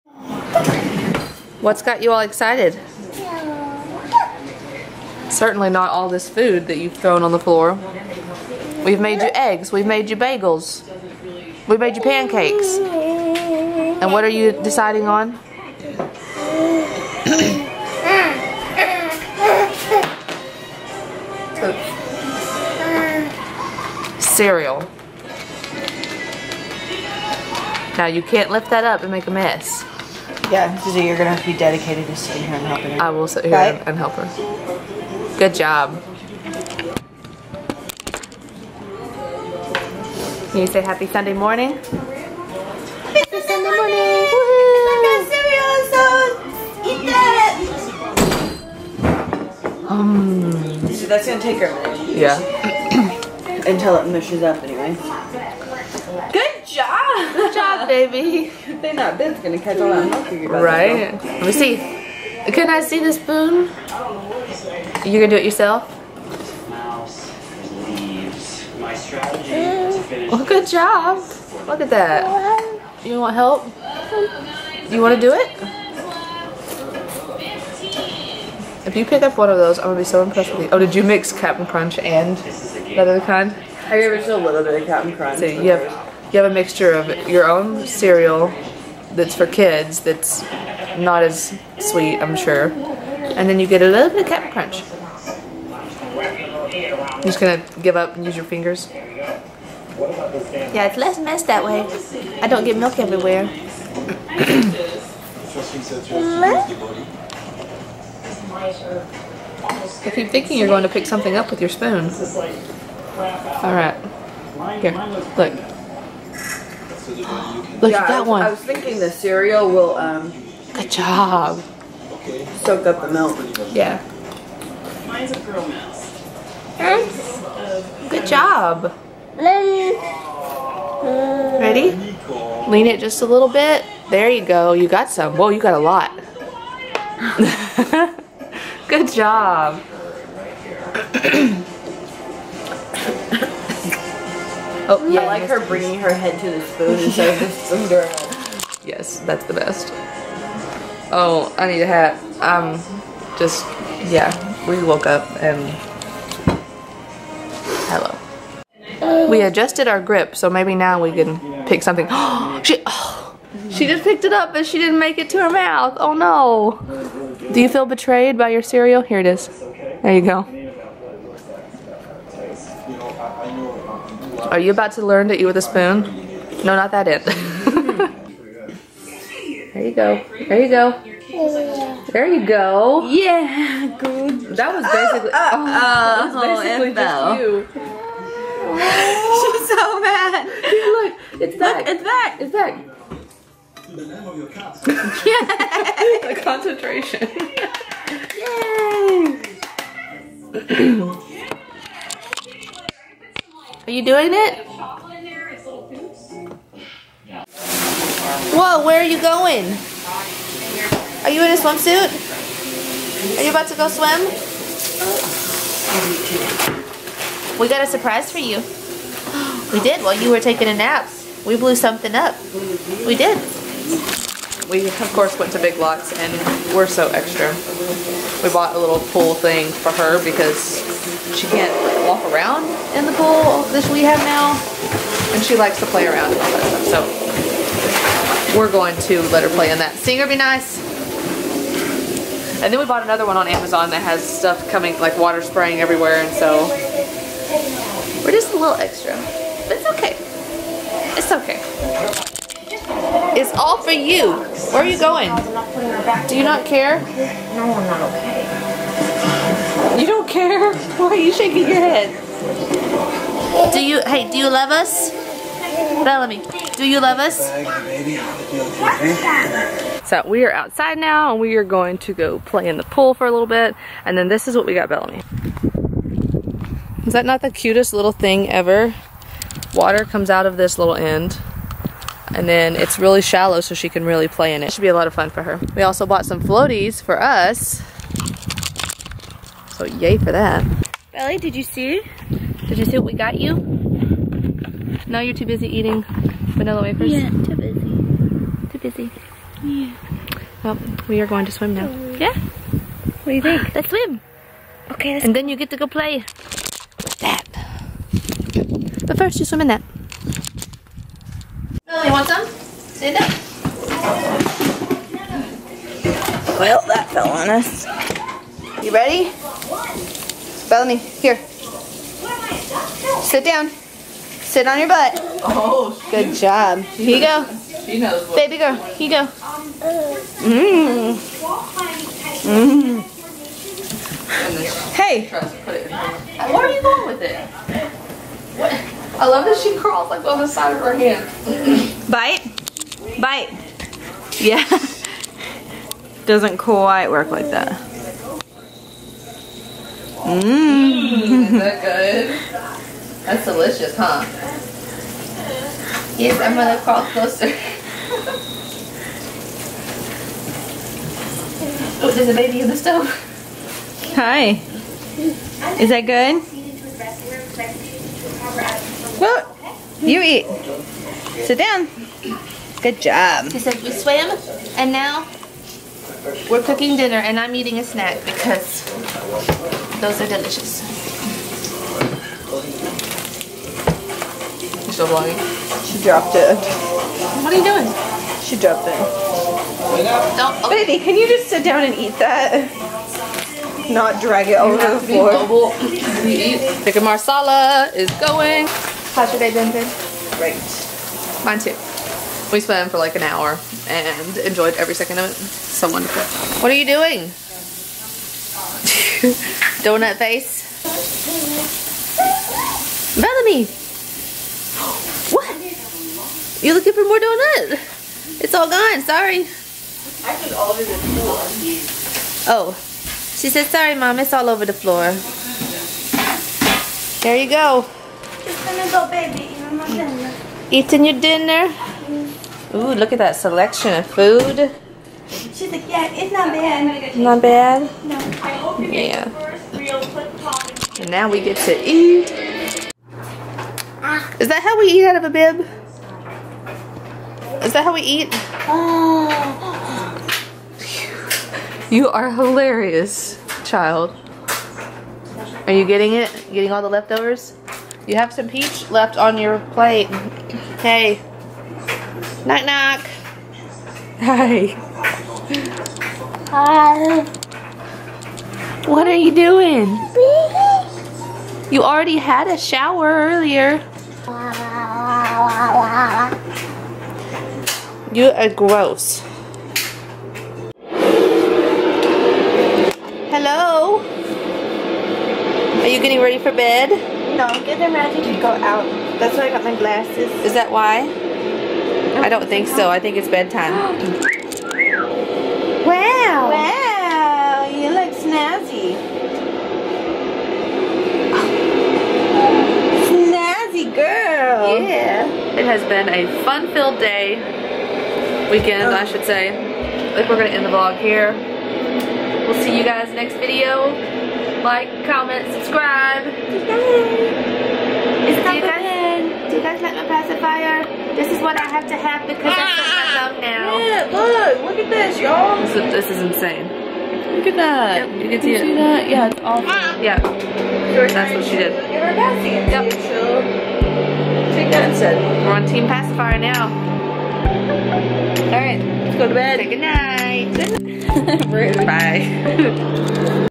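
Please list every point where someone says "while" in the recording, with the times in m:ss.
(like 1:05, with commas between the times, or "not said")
3:40.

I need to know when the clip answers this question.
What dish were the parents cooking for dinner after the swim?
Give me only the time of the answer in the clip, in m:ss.
6:36.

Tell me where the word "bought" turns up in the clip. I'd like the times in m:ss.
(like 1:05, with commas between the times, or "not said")
3:48, 4:02, 4:46.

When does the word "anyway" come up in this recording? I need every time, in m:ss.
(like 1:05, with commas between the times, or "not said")
0:54.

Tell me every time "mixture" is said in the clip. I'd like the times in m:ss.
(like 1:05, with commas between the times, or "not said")
1:26.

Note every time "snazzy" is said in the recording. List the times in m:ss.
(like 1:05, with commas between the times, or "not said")
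8:18, 8:23.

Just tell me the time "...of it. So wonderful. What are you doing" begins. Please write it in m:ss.
6:45.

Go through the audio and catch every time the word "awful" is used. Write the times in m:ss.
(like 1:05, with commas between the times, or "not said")
8:49.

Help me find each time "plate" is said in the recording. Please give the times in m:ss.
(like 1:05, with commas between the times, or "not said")
7:39.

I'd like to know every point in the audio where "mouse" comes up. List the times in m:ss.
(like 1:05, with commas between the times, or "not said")
1:06, 2:05.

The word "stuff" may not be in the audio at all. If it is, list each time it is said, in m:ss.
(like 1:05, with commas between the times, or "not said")
3:56, 4:04.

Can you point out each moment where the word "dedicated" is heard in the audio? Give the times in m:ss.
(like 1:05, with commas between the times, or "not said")
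0:31.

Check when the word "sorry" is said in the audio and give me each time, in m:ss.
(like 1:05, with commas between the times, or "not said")
6:59, 7:03.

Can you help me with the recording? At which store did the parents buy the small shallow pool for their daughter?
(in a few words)
Big Lots.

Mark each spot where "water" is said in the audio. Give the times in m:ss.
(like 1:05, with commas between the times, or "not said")
4:05, 4:39.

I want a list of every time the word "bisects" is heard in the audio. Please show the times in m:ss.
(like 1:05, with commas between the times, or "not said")
not said.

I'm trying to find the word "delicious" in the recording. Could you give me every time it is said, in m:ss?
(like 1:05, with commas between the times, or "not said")
5:53, 6:20.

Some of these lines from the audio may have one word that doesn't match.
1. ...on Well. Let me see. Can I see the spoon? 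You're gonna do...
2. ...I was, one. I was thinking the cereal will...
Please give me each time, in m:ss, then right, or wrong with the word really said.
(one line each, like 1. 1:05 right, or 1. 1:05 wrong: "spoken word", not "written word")
1. 0:59 wrong: "Right", not "Well"
2. 1:58 right.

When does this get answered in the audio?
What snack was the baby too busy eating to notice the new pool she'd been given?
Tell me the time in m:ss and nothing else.
4:56.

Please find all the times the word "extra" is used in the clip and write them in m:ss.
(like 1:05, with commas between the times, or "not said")
3:47, 4:08.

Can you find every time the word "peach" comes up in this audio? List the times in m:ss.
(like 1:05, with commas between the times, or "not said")
7:38.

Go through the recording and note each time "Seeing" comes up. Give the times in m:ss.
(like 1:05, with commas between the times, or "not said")
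3:59.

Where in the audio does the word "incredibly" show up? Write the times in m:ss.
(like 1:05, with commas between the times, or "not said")
not said.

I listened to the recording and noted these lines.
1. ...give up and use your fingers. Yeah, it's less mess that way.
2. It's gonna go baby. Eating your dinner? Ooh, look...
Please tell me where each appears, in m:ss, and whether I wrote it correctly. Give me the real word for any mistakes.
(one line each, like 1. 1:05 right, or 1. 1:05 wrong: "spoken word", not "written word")
1. 1:37 right
2. 7:08 right.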